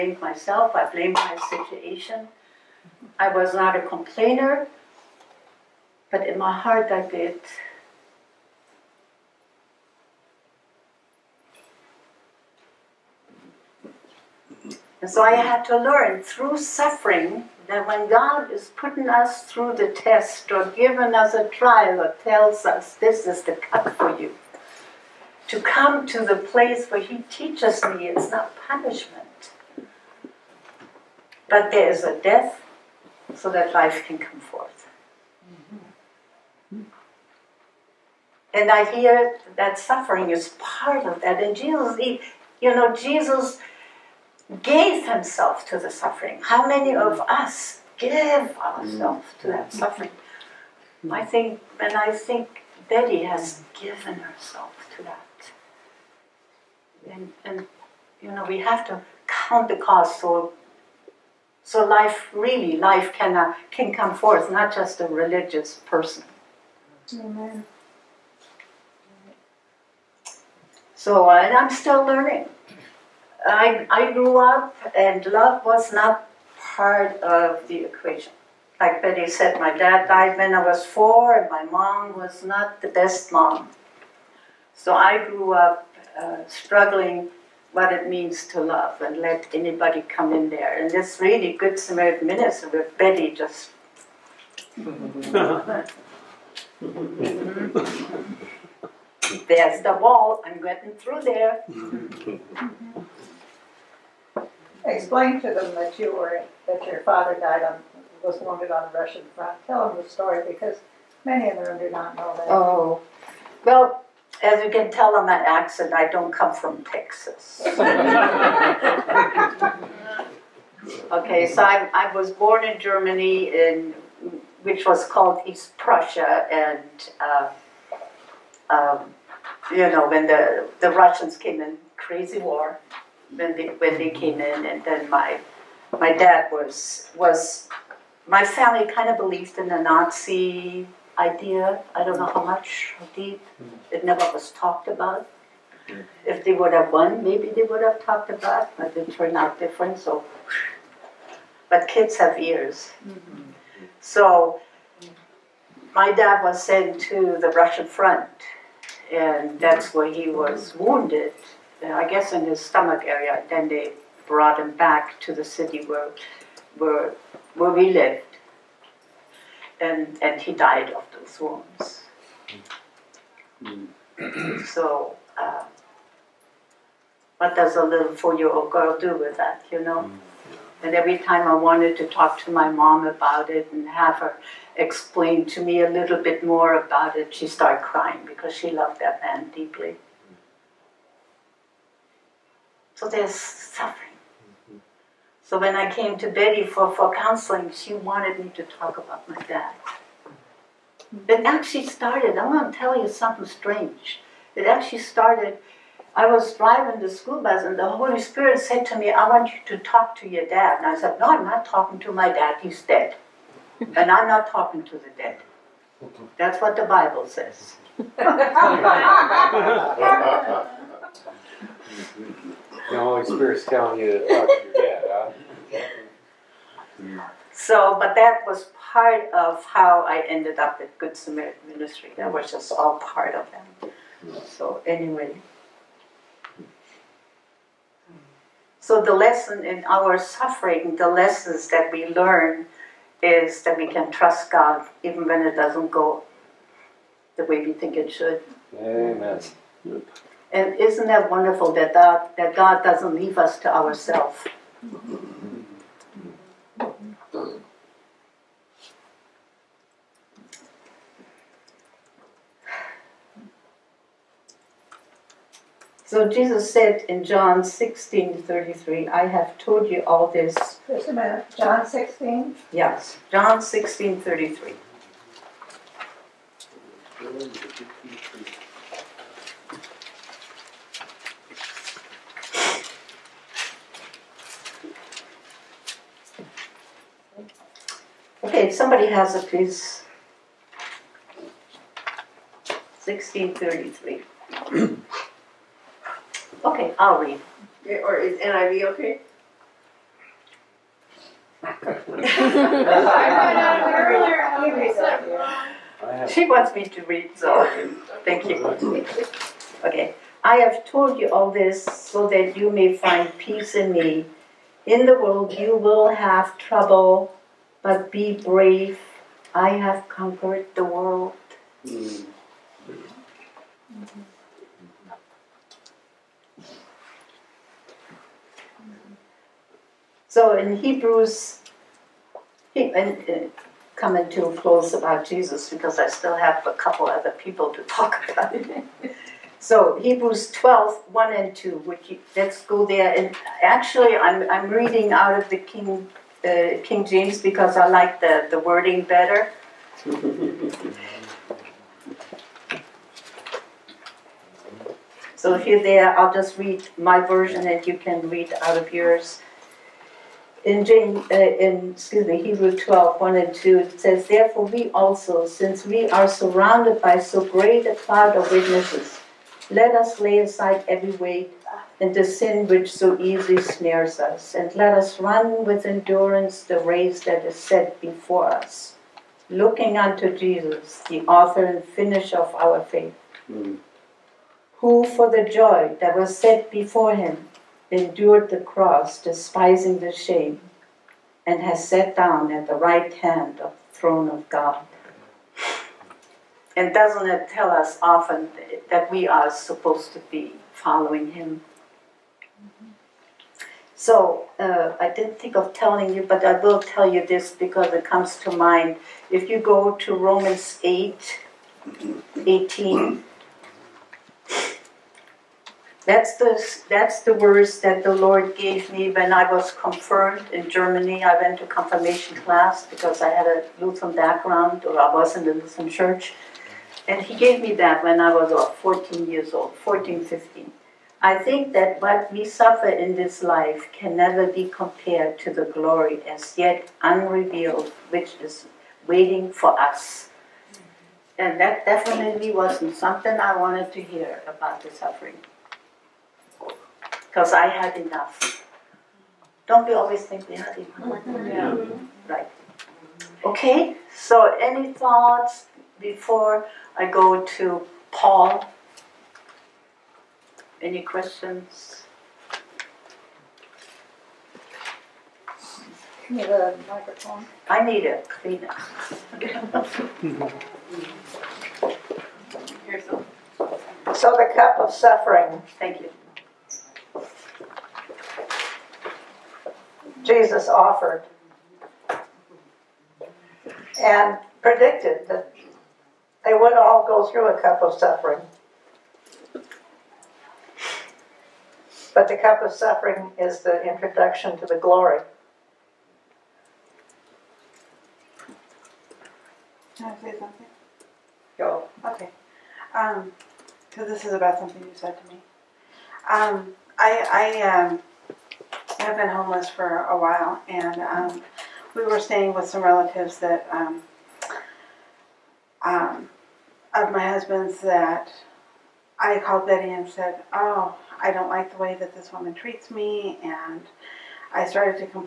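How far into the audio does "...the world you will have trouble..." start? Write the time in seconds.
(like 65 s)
315 s.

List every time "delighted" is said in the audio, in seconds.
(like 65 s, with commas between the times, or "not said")
not said.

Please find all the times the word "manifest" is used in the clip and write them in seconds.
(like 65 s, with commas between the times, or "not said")
not said.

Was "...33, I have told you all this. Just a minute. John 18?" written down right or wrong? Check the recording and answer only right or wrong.
wrong.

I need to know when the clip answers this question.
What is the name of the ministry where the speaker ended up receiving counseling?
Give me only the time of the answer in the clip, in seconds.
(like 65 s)
230 s.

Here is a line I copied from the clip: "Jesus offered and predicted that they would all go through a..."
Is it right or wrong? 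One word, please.
right.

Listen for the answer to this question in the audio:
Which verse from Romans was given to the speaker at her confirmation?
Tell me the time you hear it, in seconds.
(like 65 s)
410 s.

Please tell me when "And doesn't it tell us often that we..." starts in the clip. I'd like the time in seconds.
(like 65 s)
396 s.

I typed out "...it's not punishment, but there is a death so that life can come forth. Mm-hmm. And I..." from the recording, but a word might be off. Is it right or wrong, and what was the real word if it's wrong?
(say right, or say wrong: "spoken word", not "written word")
right.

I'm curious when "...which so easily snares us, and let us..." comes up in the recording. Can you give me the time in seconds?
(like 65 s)
372 s.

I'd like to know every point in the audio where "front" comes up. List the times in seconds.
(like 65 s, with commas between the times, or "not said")
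109 s, 157 s.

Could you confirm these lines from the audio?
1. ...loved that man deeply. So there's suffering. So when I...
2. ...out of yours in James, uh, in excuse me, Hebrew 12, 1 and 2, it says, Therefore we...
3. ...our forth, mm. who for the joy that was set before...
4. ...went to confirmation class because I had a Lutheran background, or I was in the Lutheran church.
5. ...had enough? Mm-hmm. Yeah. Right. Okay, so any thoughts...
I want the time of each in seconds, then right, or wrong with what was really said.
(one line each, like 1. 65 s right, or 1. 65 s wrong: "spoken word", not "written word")
1. 188 s right
2. 358 s right
3. 382 s wrong: "faith", not "forth"
4. 421 s right
5. 450 s right.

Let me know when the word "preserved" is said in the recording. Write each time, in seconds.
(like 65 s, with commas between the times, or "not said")
not said.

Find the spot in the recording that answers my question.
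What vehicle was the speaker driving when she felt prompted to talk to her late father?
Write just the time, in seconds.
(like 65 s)
207 s.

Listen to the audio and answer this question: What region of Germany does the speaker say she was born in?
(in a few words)
East Prussia.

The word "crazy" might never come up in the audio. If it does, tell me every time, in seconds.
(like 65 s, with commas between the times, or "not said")
131 s.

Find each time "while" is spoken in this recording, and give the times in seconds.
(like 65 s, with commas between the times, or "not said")
510 s.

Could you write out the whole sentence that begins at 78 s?
Like Betty said, my dad died when I was four and my mom was not the best mom.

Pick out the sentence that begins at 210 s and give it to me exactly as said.
And I said, No, I'm not talking to my dad, he's dead.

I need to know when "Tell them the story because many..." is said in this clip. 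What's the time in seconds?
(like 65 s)
109 s.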